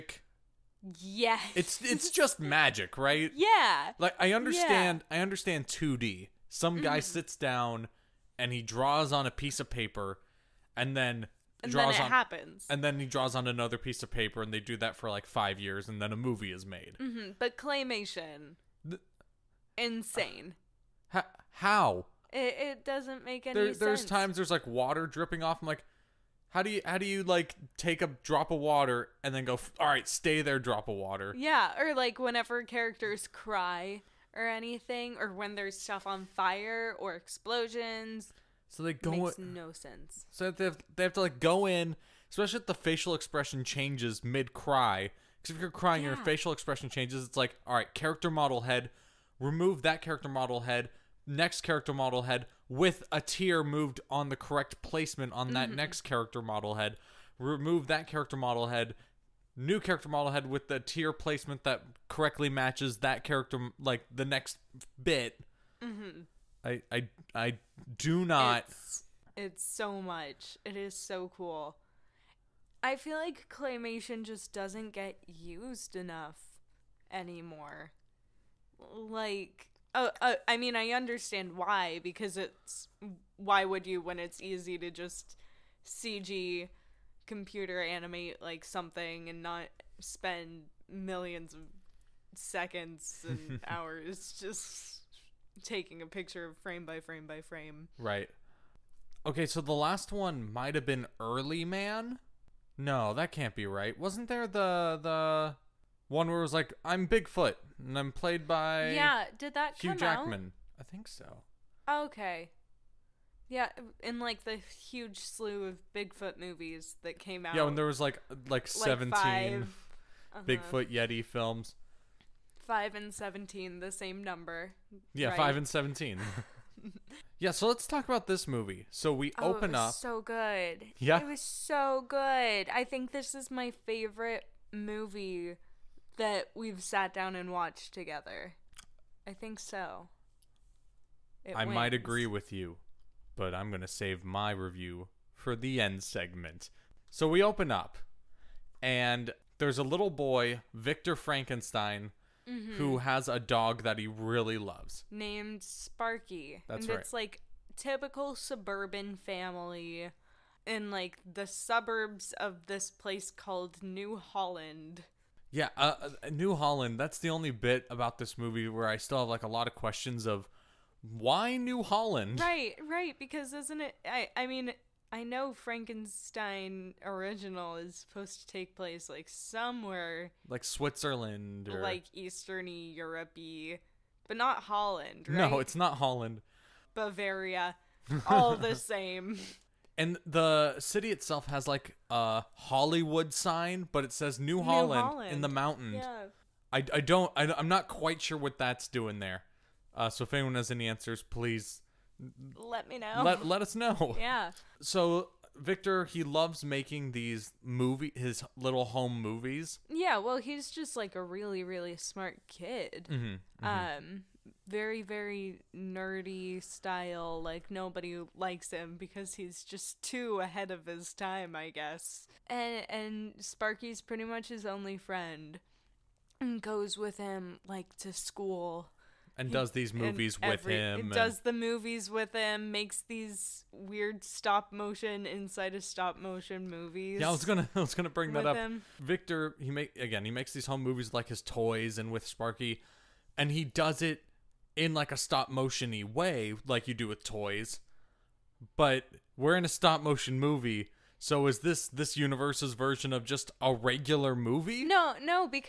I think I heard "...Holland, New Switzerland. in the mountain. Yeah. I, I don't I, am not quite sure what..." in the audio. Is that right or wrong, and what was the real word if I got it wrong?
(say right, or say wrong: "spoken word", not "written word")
wrong: "Holland", not "Switzerland".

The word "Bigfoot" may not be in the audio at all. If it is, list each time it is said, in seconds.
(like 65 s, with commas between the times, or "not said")
107 s, 115 s, 120 s.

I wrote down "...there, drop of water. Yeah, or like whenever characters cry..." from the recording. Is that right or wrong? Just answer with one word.
right.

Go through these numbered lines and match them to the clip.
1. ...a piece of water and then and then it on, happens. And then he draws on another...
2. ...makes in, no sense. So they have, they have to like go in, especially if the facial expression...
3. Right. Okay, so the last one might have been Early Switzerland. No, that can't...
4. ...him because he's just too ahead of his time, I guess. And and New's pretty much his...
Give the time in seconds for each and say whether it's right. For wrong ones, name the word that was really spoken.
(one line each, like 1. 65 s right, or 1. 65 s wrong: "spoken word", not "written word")
1. 9 s wrong: "paper", not "water"
2. 39 s right
3. 97 s wrong: "Man", not "Switzerland"
4. 218 s wrong: "Sparky", not "New".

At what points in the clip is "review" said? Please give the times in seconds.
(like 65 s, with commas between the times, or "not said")
144 s.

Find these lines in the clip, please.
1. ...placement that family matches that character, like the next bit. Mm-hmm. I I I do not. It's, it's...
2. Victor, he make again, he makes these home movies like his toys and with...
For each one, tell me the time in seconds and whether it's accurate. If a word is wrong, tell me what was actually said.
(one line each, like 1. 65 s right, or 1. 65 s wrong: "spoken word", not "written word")
1. 61 s wrong: "correctly", not "family"
2. 238 s right.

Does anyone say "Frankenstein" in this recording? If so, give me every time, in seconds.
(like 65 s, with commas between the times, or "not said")
151 s, 175 s.